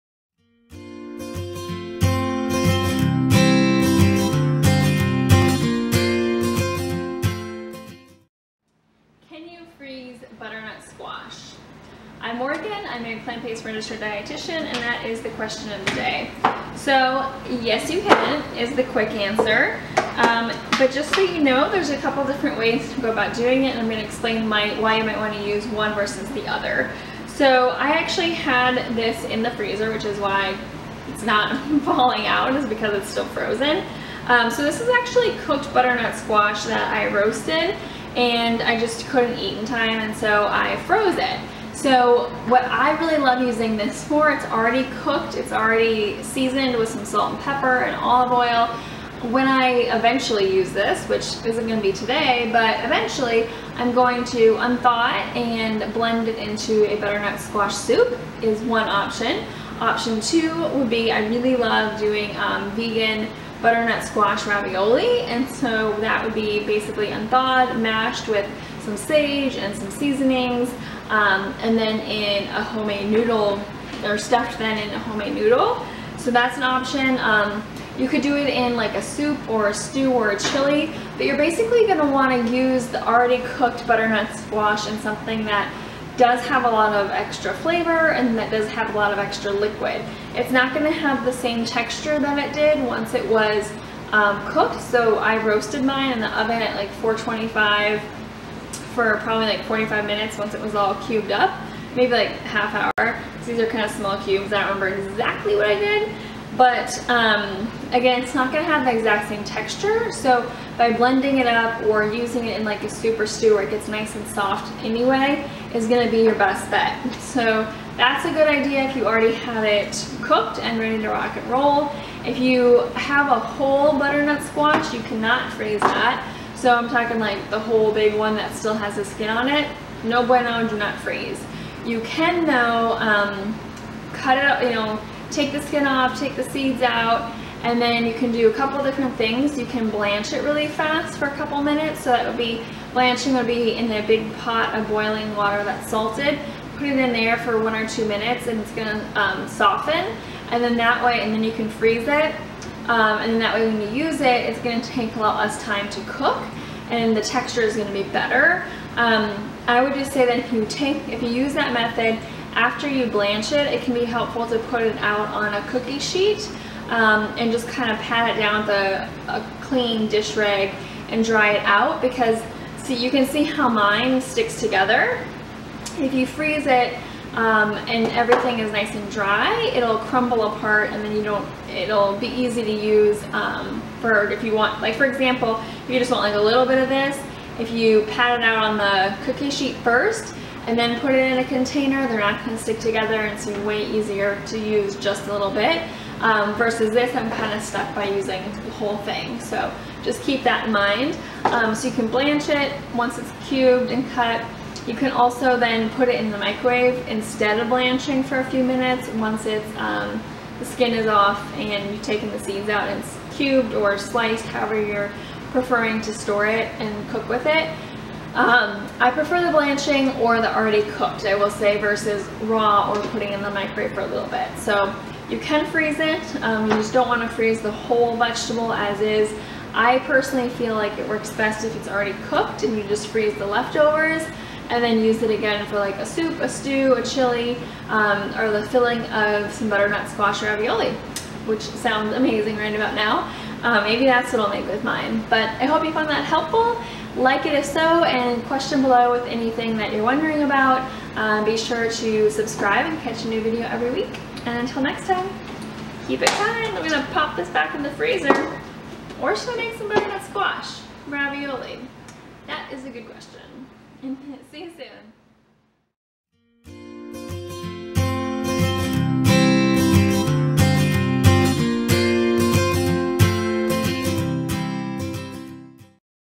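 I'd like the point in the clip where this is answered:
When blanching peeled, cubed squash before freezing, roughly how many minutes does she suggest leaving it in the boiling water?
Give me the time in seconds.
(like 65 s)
147 s.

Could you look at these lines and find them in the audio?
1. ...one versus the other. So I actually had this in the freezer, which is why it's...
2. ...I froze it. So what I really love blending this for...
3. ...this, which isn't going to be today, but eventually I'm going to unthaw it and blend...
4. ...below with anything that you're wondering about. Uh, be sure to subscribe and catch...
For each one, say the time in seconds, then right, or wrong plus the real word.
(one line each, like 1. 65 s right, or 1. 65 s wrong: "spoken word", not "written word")
1. 25 s right
2. 40 s wrong: "using", not "blending"
3. 50 s right
4. 248 s right.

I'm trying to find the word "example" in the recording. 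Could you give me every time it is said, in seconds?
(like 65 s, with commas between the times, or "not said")
185 s.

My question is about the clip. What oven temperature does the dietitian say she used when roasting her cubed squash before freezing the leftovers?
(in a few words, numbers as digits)
425.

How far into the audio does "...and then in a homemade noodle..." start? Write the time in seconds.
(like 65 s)
71 s.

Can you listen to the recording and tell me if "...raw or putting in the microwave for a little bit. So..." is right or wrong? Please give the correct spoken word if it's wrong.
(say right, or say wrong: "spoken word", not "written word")
right.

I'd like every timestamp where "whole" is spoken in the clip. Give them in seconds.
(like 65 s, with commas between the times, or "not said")
123 s, 127 s, 198 s, 227 s.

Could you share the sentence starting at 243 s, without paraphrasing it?
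Uh, maybe that's what I'll make with mine.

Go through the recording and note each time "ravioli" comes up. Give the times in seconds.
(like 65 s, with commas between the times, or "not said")
64 s, 240 s, 261 s.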